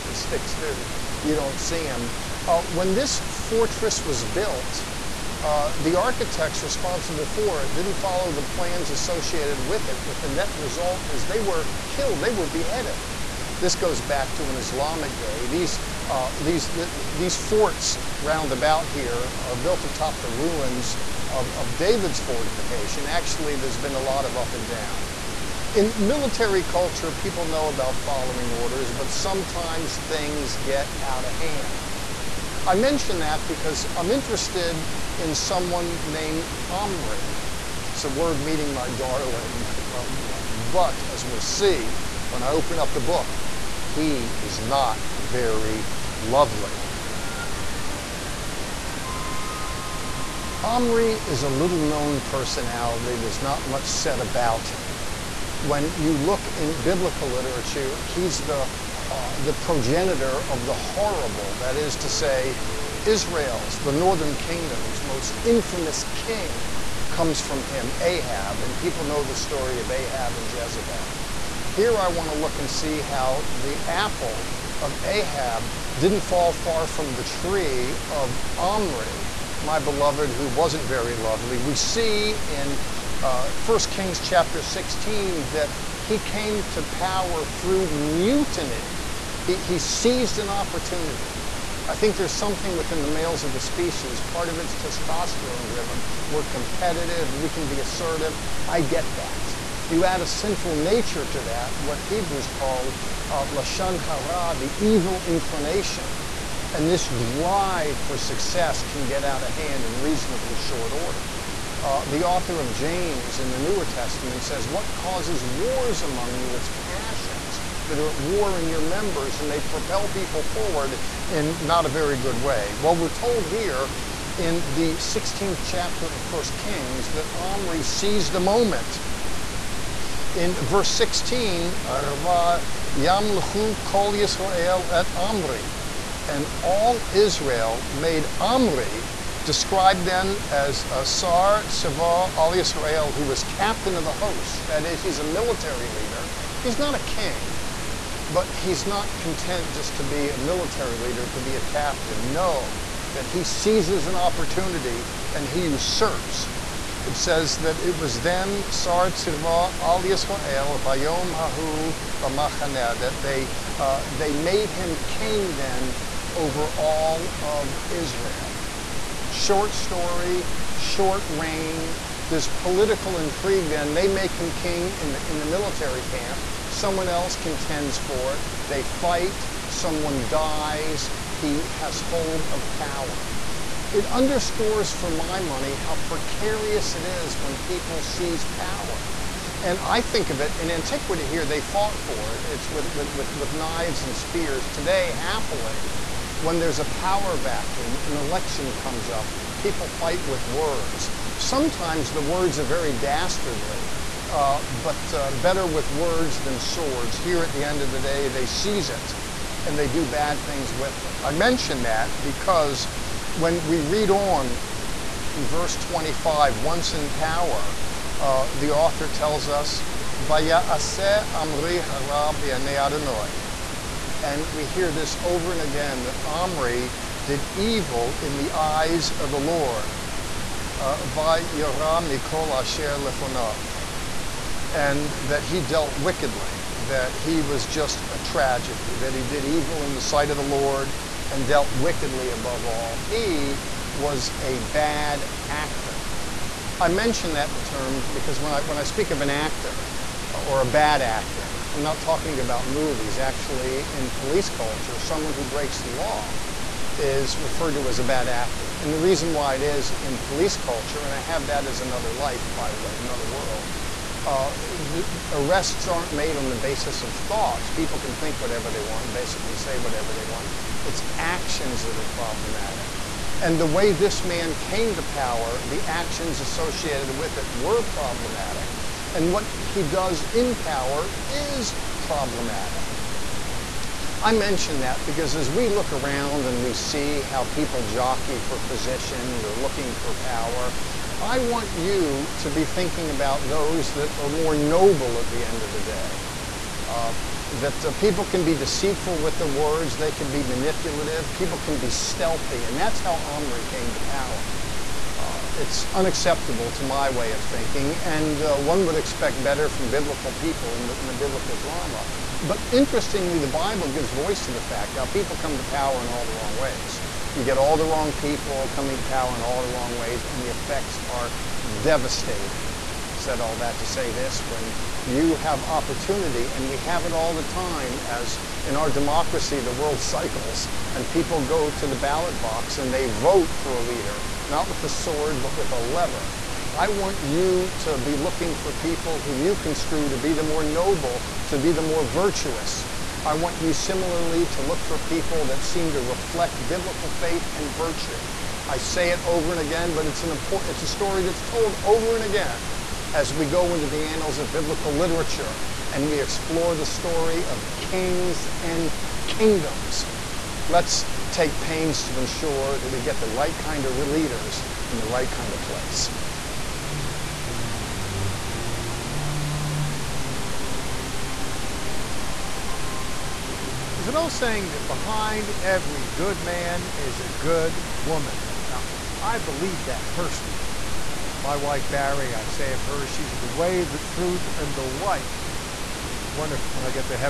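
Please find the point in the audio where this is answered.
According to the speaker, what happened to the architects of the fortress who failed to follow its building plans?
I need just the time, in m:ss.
0:12.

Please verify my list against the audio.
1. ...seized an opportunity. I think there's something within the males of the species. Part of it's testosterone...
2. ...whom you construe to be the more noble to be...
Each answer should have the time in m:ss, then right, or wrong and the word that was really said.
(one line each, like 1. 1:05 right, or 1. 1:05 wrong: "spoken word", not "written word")
1. 1:29 right
2. 5:39 right.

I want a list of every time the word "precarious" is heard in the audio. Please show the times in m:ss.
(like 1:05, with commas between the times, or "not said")
3:05.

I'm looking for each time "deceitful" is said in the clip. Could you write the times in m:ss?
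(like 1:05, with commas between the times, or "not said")
4:58.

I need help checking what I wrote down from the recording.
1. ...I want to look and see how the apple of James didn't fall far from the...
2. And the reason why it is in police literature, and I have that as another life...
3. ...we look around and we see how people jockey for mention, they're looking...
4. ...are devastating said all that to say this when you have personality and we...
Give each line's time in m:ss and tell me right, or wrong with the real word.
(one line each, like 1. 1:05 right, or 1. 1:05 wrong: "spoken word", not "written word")
1. 1:11 wrong: "Ahab", not "James"
2. 4:18 wrong: "culture", not "literature"
3. 4:45 wrong: "position", not "mention"
4. 5:21 wrong: "opportunity", not "personality".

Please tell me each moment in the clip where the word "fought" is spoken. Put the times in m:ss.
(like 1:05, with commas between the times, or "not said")
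3:11.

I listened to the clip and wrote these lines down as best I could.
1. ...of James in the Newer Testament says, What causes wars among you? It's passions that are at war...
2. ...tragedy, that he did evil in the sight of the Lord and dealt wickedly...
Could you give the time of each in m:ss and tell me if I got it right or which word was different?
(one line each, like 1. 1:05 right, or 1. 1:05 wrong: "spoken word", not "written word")
1. 1:52 right
2. 3:58 right.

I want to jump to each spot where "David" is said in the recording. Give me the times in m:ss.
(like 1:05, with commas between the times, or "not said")
0:21.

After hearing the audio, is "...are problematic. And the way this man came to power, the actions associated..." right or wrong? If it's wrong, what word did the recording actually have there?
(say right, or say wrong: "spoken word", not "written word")
right.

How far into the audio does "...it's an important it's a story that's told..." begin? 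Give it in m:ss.
5:50.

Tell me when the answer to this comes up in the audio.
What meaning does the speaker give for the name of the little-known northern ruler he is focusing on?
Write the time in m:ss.
0:38.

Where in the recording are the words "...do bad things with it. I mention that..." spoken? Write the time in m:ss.
3:29.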